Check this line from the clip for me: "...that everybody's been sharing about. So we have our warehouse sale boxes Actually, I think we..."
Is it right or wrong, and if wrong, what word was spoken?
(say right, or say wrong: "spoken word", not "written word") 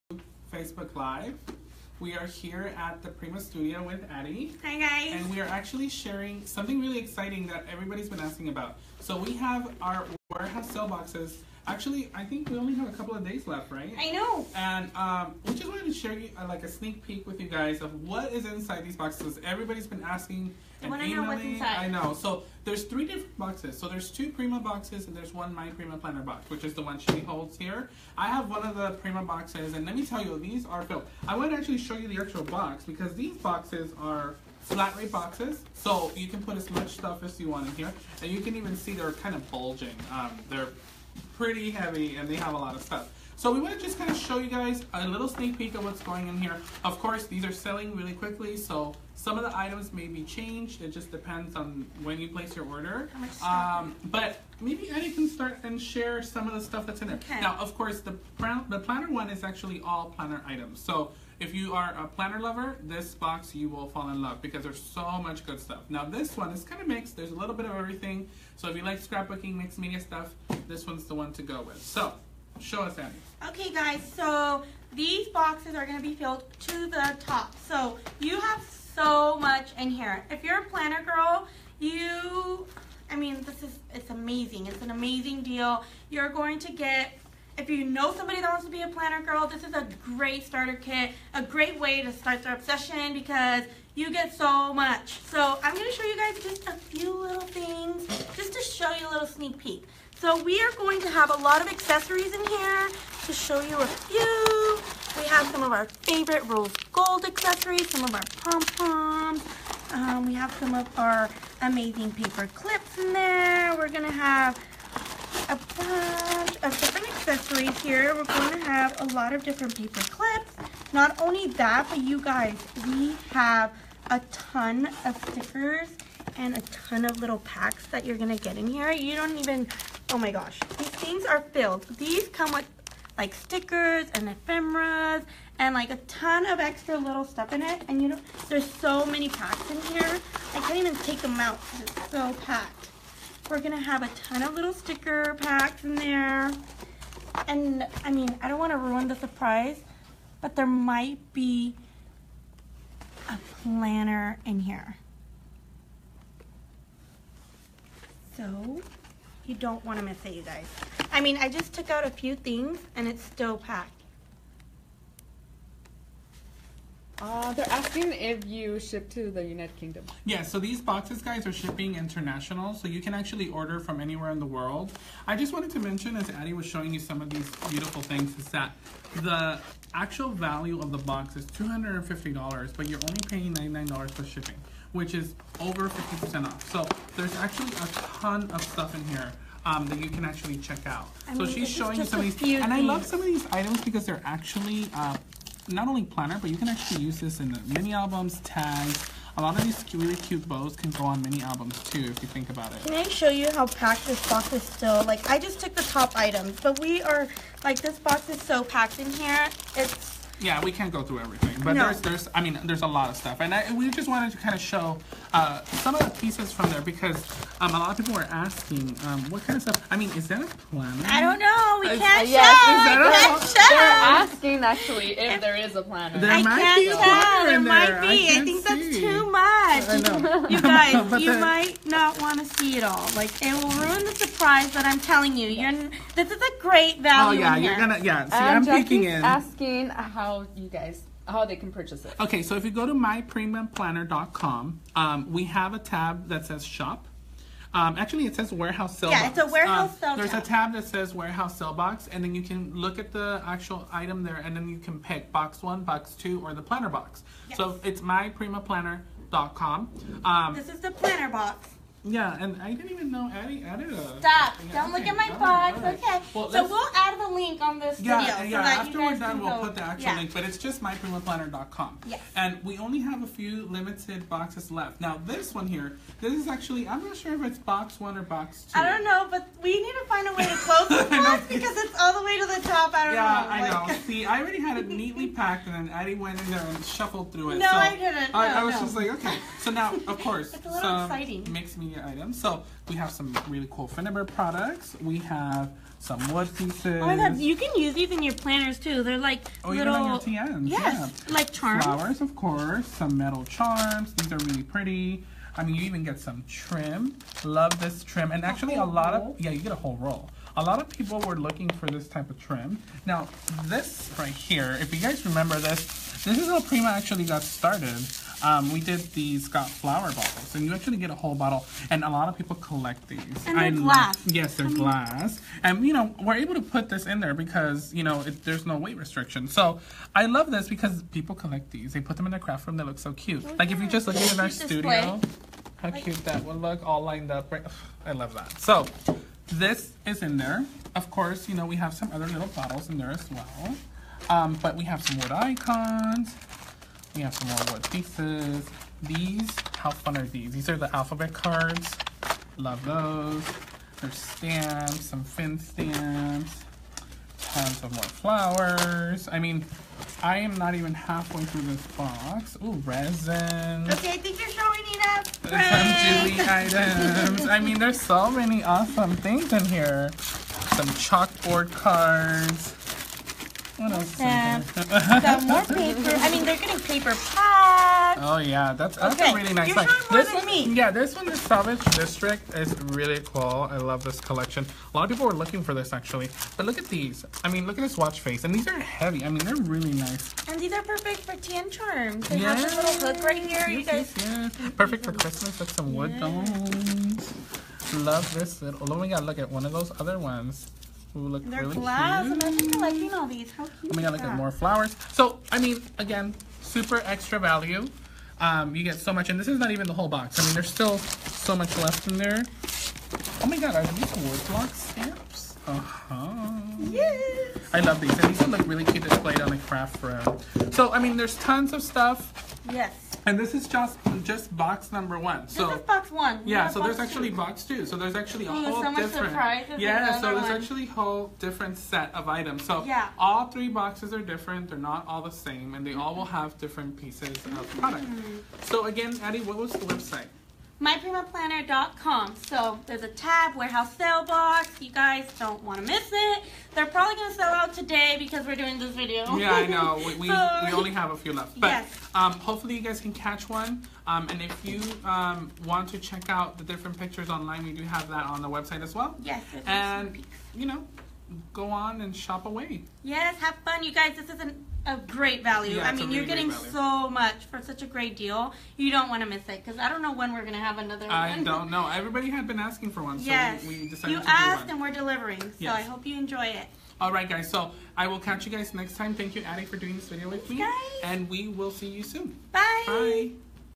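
wrong: "asking", not "sharing".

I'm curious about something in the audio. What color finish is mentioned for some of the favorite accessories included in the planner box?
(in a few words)
rose gold.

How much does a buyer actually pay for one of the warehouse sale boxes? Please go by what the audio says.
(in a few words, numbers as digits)
$99.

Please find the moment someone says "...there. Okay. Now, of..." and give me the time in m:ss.
0:57.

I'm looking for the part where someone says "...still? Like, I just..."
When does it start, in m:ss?
3:24.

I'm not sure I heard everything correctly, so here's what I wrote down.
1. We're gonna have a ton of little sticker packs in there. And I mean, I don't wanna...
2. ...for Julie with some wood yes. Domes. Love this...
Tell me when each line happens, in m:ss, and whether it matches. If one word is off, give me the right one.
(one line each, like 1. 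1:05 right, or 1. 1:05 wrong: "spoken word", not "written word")
1. 2:23 right
2. 6:35 wrong: "Christmas", not "Julie".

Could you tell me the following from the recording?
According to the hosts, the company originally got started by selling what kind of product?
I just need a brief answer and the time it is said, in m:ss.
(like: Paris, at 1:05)
flower bottles, at 5:19.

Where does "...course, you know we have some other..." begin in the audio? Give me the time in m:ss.
5:41.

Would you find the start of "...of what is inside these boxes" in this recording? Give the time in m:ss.
0:17.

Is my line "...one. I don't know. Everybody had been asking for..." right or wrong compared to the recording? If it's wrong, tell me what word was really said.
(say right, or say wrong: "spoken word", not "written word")
right.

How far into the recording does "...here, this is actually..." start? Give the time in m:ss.
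4:35.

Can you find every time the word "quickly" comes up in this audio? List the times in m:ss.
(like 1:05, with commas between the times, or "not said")
0:48.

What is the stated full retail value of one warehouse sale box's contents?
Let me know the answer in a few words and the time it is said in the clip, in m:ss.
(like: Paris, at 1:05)
$250, at 3:01.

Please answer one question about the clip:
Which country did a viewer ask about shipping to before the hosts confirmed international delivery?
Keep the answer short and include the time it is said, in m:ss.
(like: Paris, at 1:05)
United Kingdom, at 2:49.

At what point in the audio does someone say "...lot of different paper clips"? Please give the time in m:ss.
1:59.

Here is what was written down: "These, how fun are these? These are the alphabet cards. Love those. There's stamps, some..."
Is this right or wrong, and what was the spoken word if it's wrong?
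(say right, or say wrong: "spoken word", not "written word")
right.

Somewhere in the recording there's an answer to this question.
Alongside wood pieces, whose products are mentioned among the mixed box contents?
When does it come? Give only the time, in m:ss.
4:53.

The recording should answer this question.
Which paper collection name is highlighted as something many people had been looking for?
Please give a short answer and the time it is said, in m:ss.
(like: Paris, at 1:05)
Salvage District, at 6:21.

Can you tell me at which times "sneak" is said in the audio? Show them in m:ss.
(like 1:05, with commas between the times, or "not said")
0:16, 0:45, 1:39.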